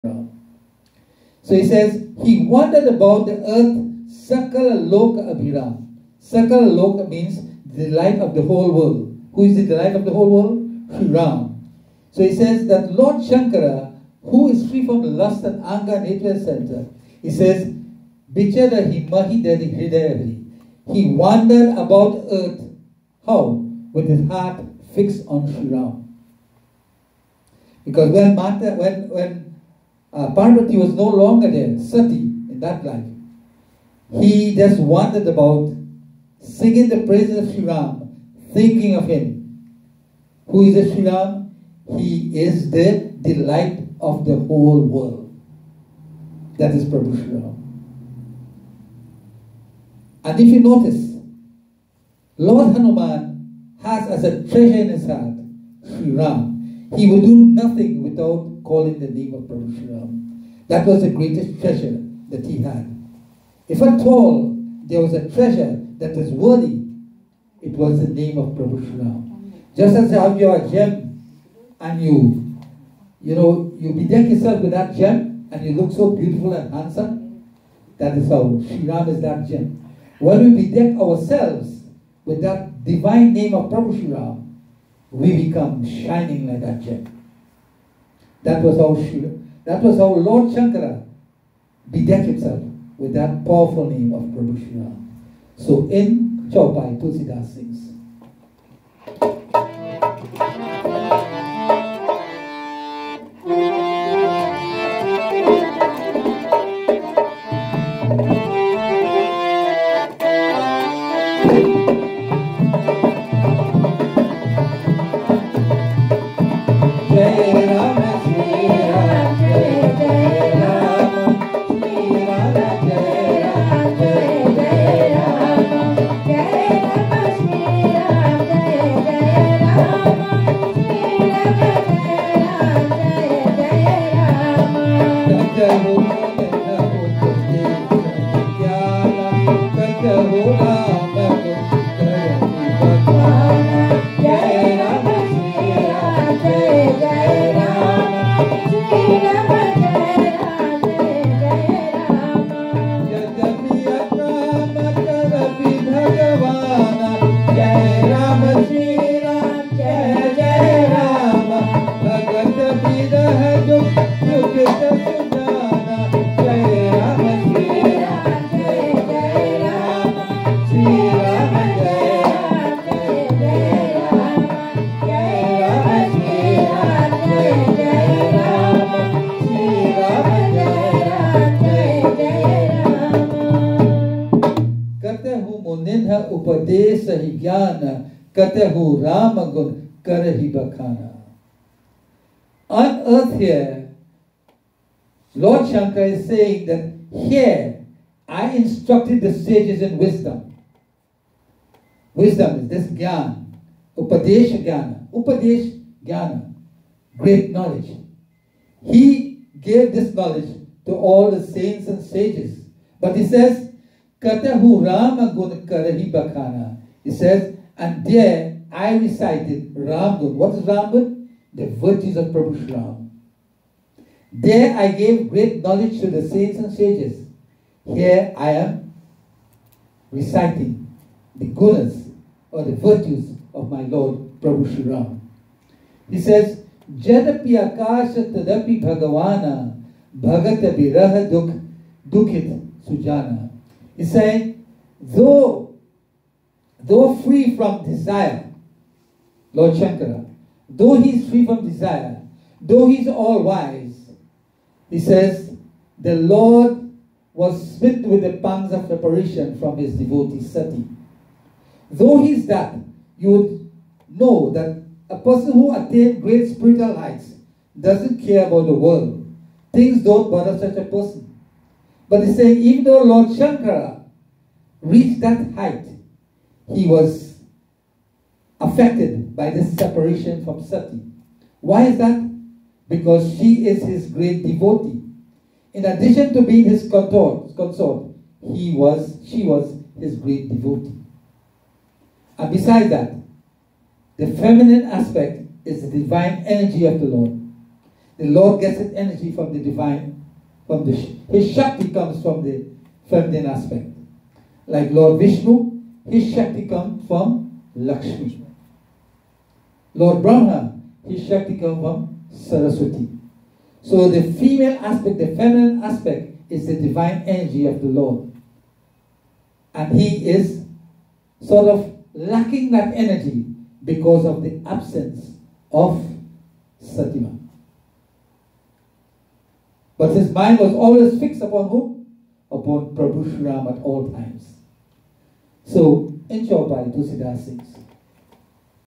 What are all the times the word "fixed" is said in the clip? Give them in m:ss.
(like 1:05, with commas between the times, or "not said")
0:24, 5:31.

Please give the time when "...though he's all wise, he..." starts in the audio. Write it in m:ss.
4:12.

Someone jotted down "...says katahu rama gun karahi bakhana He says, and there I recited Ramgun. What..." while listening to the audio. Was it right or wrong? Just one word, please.
right.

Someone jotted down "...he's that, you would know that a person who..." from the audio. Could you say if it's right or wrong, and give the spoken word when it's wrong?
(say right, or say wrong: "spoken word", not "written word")
right.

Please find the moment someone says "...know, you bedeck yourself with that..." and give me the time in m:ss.
1:13.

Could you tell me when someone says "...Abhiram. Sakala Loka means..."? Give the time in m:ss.
0:05.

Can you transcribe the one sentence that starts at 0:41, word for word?
He is the delight of the whole world.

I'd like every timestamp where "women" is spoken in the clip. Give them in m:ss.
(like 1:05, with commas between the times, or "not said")
not said.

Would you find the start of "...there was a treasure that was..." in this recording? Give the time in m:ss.
1:04.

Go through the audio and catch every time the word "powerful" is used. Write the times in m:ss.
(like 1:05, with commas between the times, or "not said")
1:33.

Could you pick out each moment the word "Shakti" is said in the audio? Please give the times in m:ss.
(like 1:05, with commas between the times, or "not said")
5:01, 5:06, 5:11.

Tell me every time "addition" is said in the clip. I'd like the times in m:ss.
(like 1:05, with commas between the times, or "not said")
4:45.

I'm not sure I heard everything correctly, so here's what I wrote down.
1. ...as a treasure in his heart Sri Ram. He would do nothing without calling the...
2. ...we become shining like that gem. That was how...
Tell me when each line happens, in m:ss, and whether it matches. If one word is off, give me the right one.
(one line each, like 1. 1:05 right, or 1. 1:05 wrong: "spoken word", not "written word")
1. 0:54 right
2. 1:25 right.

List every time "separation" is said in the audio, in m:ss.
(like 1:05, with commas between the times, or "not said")
4:18, 4:39.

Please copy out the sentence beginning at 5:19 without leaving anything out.
And he is sort of lacking that energy because of the absence of Satima.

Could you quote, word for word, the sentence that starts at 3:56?
He says, Jadapi akama tadapi bhagavana bhagata viraha dukh dukhit sujana.